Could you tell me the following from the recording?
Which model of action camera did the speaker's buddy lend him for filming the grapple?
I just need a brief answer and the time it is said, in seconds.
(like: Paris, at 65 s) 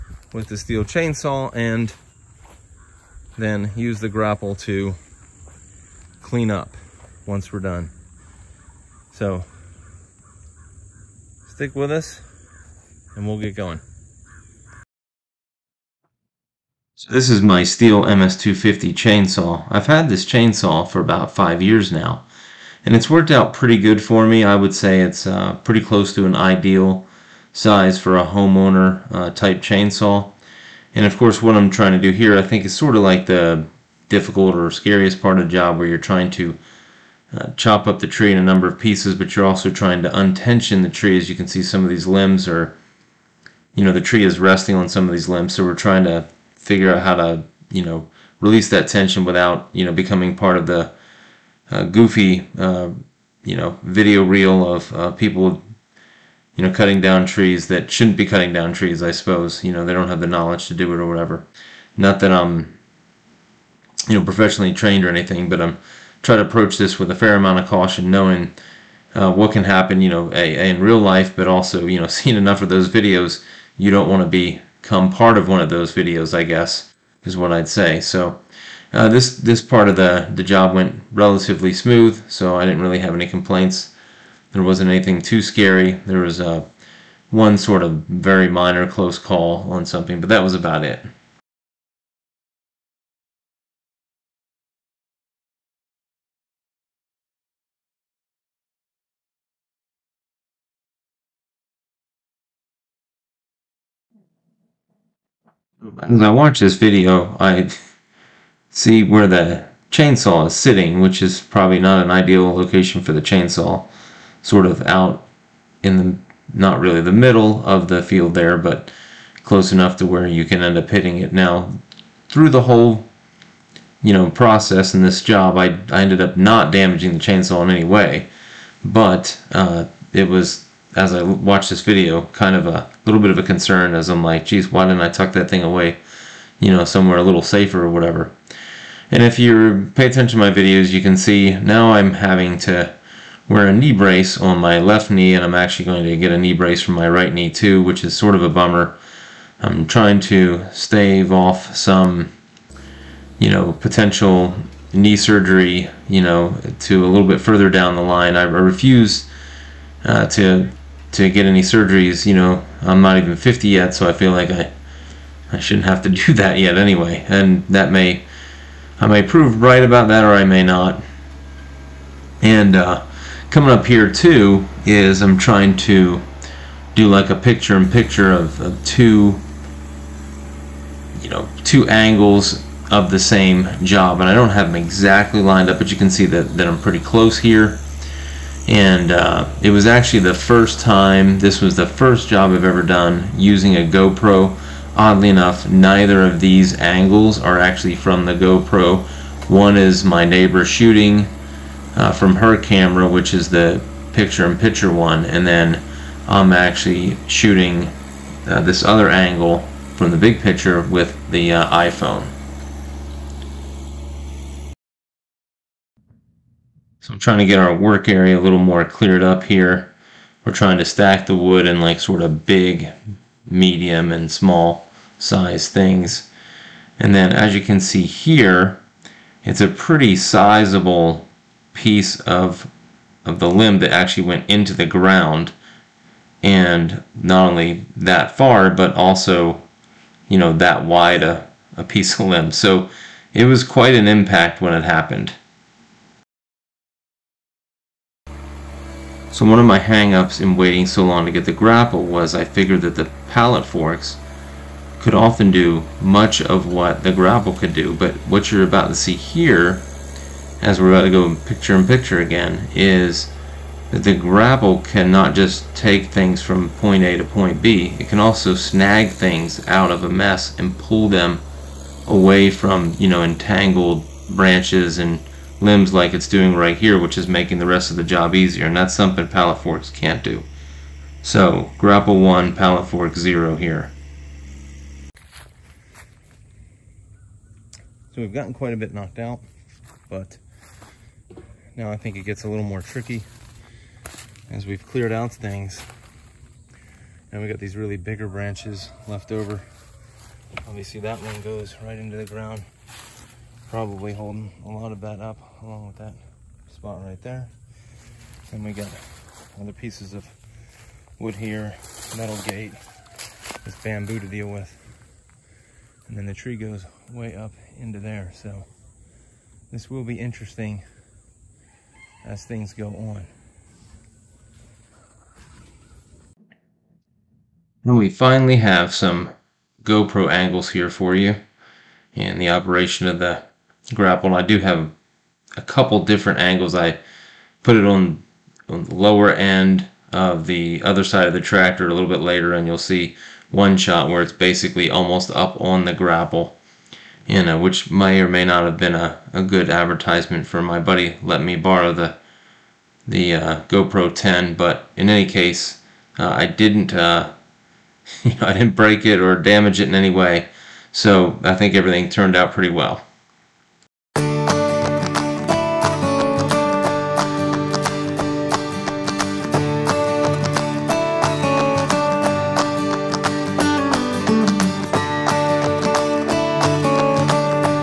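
GoPro 10, at 353 s.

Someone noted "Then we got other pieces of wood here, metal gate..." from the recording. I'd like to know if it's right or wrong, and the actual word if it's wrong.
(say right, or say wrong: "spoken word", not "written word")
right.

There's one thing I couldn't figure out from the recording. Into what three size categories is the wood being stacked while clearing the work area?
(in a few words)
big, medium, and small.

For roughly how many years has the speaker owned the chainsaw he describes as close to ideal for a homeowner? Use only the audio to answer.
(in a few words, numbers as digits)
5.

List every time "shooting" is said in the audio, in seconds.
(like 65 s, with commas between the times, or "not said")
200 s, 207 s.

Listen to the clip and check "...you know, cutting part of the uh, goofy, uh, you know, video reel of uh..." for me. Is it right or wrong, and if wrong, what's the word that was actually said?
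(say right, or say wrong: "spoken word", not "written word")
wrong: "becoming", not "cutting".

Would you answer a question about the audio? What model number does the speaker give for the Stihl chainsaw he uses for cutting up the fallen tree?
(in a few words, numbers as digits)
MS250.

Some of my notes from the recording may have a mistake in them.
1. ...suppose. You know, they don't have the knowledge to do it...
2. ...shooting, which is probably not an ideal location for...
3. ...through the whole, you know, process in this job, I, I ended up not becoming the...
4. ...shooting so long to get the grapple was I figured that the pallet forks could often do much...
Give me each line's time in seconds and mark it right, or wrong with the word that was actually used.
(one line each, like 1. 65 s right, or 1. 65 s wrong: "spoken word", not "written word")
1. 59 s right
2. 110 s wrong: "sitting", not "shooting"
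3. 122 s wrong: "damaging", not "becoming"
4. 250 s wrong: "waiting", not "shooting".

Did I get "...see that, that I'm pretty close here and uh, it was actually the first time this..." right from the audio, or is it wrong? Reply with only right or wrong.
right.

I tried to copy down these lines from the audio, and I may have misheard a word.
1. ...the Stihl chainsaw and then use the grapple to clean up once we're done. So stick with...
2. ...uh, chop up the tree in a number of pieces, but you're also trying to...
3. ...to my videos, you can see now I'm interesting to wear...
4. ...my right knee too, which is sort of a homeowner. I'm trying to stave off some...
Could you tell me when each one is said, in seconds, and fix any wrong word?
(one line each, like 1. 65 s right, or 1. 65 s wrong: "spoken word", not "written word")
1. 0 s right
2. 37 s right
3. 140 s wrong: "having", not "interesting"
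4. 146 s wrong: "bummer", not "homeowner".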